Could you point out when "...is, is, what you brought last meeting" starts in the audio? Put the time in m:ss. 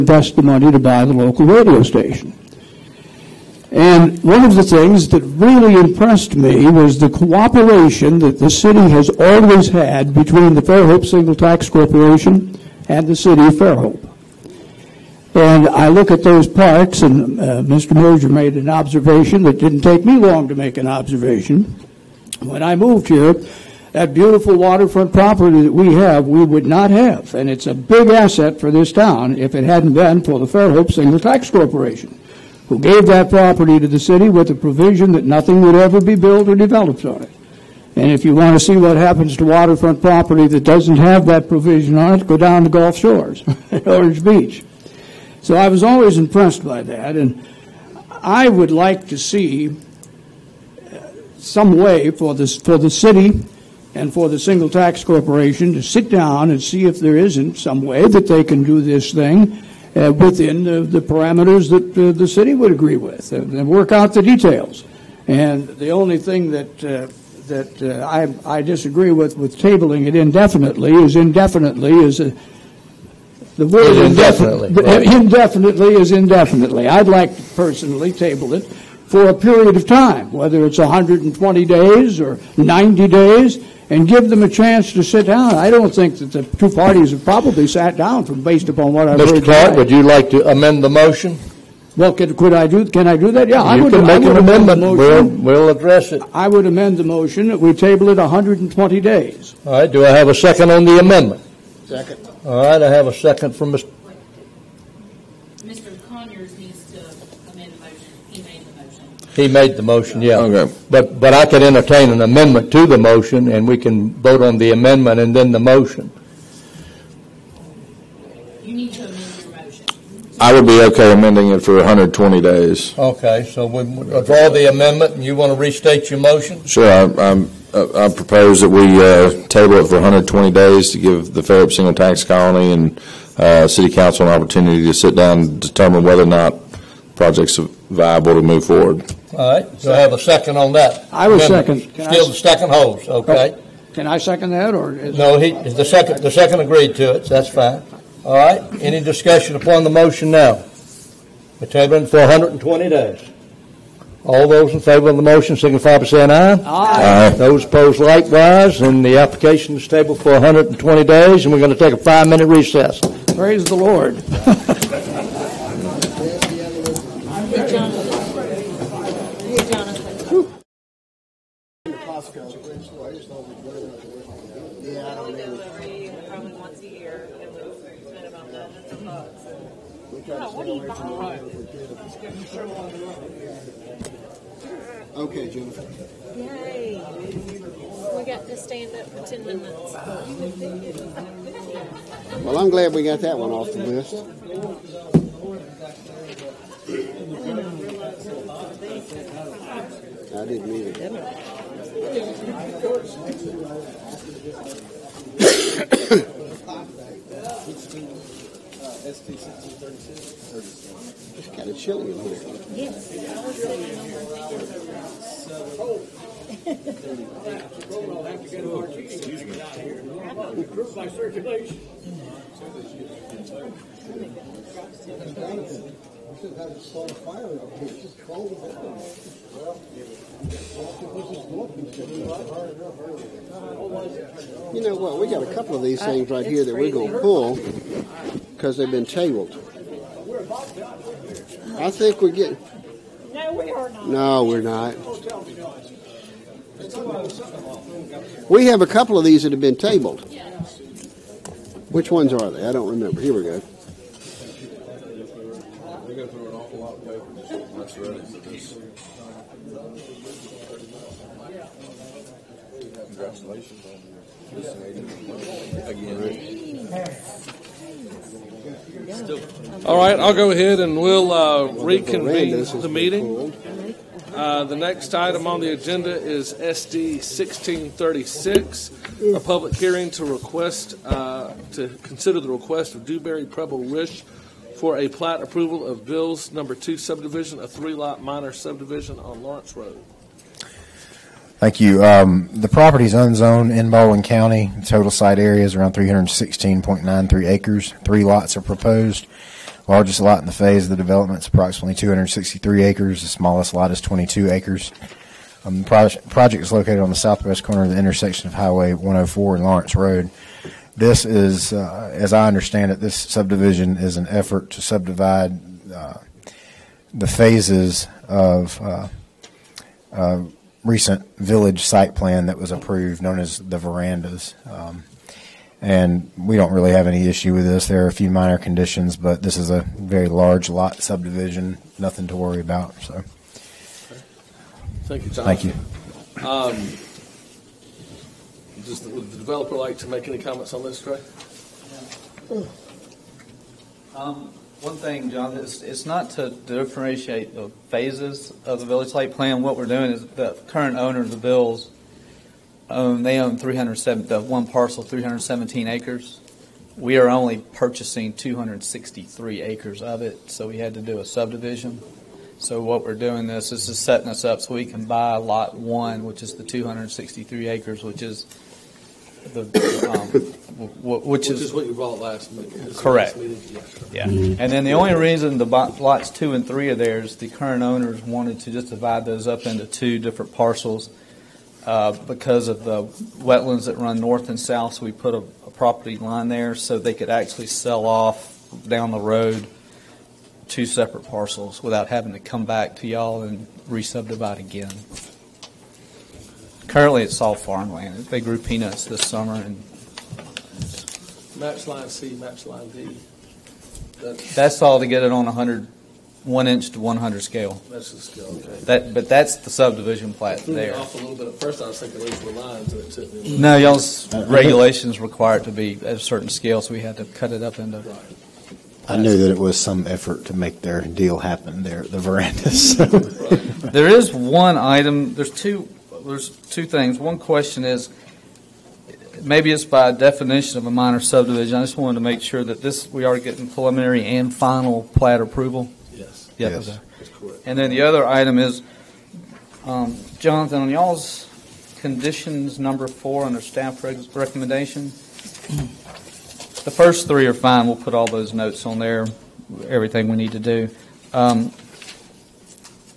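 6:11.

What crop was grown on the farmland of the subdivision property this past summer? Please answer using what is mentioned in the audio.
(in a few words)
Peanuts.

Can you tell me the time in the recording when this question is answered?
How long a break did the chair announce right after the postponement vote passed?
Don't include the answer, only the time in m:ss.
2:41.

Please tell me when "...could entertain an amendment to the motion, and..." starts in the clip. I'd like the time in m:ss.
1:51.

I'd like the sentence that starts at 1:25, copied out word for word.
I don't think that the two parties have probably sat down from based upon what I've Mr.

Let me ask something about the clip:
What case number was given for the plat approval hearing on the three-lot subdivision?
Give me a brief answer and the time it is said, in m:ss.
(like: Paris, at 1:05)
SD 1636, at 4:36.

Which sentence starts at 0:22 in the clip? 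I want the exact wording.
When I moved here, that beautiful waterfront property that we have, we would not have.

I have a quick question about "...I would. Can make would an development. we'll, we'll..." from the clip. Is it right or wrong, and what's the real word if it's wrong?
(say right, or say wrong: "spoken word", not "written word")
wrong: "amendment", not "development".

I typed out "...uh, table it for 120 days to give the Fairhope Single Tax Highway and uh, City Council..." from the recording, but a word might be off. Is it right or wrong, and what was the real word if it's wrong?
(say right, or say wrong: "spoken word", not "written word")
wrong: "Colony", not "Highway".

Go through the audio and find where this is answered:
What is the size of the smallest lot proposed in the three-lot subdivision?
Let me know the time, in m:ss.
5:04.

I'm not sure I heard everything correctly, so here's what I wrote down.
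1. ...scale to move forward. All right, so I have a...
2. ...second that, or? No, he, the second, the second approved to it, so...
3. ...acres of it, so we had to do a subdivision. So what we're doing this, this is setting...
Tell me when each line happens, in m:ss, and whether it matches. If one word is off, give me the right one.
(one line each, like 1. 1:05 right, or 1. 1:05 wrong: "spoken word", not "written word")
1. 2:17 wrong: "viable", not "scale"
2. 2:24 wrong: "agreed", not "approved"
3. 5:59 right.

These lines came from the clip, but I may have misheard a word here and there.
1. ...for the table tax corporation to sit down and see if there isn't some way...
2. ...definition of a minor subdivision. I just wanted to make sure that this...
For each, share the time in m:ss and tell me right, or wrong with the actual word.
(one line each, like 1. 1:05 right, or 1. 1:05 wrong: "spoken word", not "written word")
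1. 0:54 wrong: "single", not "table"
2. 7:10 right.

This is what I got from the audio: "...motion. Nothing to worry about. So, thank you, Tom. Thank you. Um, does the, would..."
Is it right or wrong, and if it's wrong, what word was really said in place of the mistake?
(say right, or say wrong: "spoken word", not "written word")
wrong: "subdivision", not "motion".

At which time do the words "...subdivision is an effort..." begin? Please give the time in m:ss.
5:13.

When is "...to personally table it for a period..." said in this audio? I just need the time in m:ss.
1:17.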